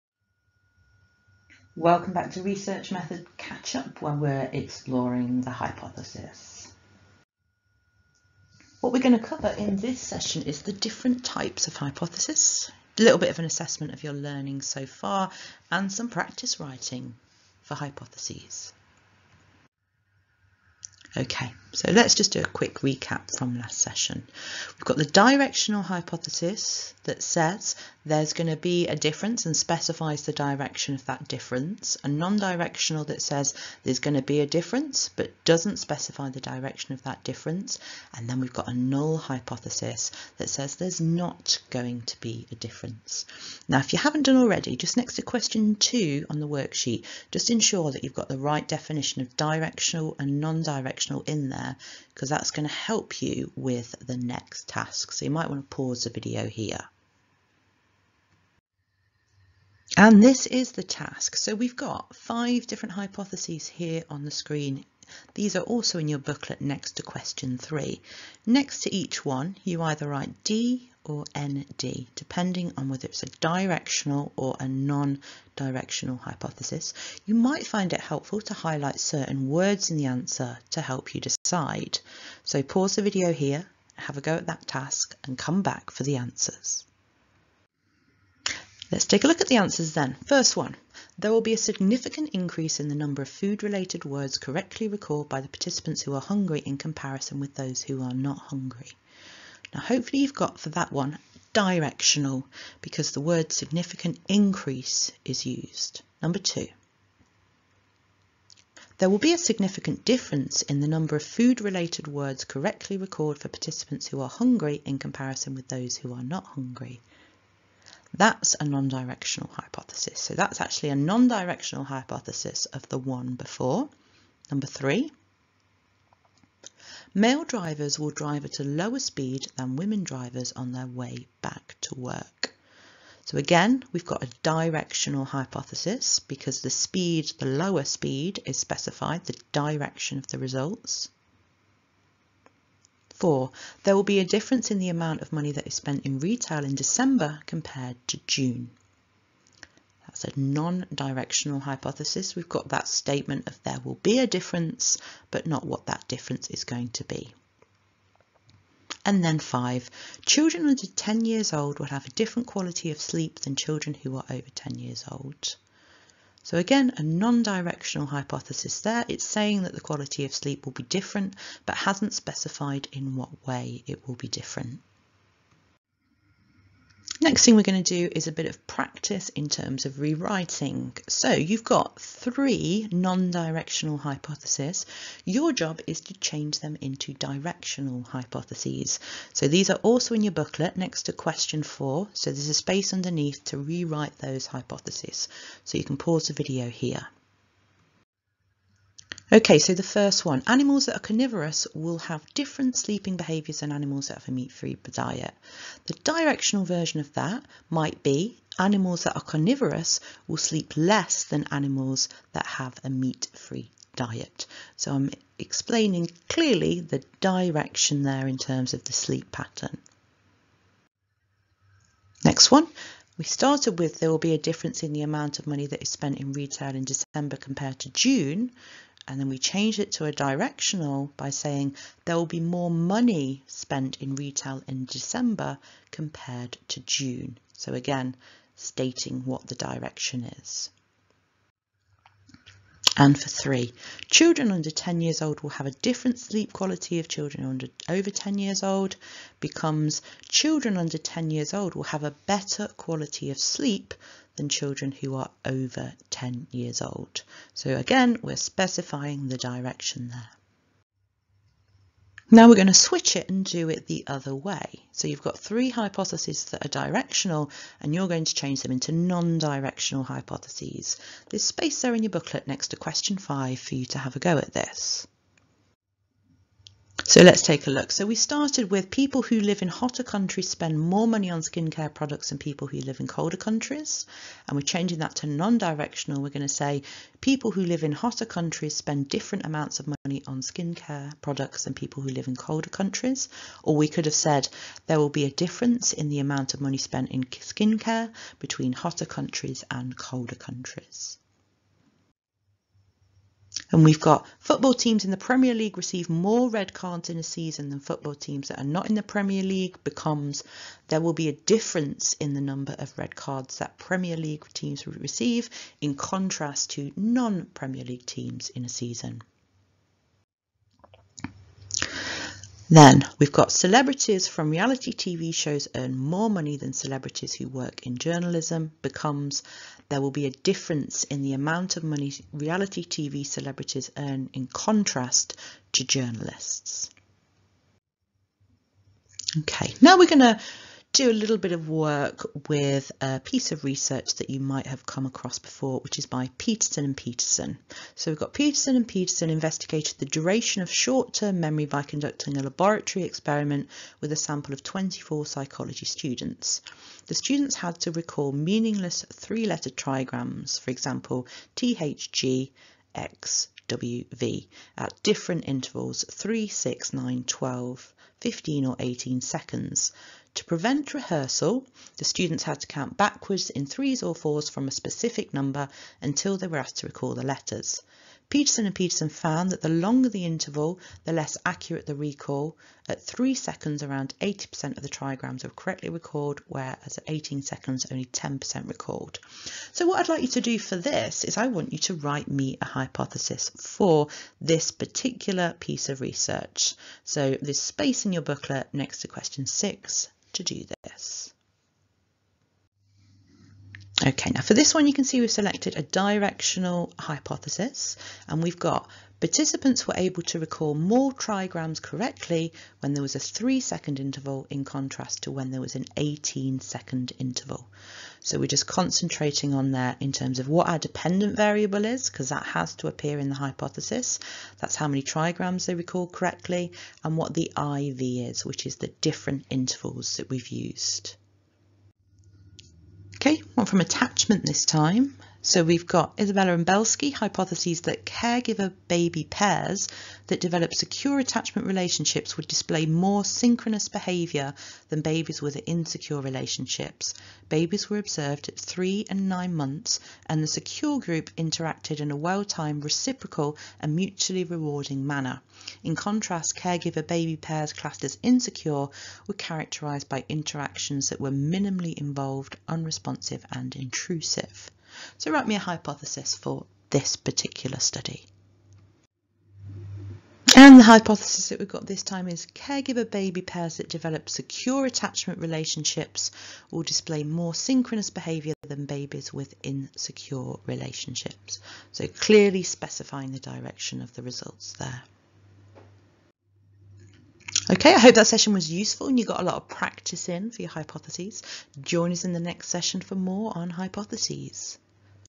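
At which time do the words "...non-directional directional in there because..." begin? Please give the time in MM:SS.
00:50.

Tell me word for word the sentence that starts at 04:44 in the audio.
And we're changing that to non-directional.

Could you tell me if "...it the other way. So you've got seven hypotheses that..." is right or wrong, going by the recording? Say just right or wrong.
wrong.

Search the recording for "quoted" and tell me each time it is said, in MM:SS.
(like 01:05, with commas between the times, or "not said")
not said.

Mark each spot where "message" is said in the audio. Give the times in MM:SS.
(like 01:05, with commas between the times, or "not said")
not said.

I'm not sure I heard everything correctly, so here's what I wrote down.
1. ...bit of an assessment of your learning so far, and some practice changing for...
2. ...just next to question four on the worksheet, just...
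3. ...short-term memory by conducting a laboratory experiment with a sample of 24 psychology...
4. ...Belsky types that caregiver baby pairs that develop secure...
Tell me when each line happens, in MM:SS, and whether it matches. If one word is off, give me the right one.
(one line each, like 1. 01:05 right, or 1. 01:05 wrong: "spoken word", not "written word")
1. 00:13 wrong: "writing", not "changing"
2. 00:44 wrong: "two", not "four"
3. 05:50 right
4. 07:16 wrong: "hypotheses", not "types".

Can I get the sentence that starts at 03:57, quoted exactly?
So again, stating what the direction is and for three.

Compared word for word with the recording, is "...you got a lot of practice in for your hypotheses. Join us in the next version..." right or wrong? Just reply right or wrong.
wrong.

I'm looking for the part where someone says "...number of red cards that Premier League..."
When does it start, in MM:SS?
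05:12.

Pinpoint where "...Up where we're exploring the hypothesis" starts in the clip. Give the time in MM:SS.
00:03.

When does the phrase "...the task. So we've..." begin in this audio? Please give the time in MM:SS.
01:00.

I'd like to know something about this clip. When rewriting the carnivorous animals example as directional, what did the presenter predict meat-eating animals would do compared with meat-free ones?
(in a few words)
sleep less.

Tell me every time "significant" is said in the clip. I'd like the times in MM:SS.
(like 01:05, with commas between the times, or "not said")
01:31, 01:43, 01:49.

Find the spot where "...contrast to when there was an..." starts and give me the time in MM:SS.
06:54.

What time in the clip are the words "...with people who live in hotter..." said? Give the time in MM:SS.
04:38.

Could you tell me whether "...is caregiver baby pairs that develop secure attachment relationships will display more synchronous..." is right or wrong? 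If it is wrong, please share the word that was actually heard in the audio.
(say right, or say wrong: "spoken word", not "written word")
right.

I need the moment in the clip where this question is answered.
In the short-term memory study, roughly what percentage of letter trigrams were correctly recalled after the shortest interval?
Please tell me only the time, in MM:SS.
06:24.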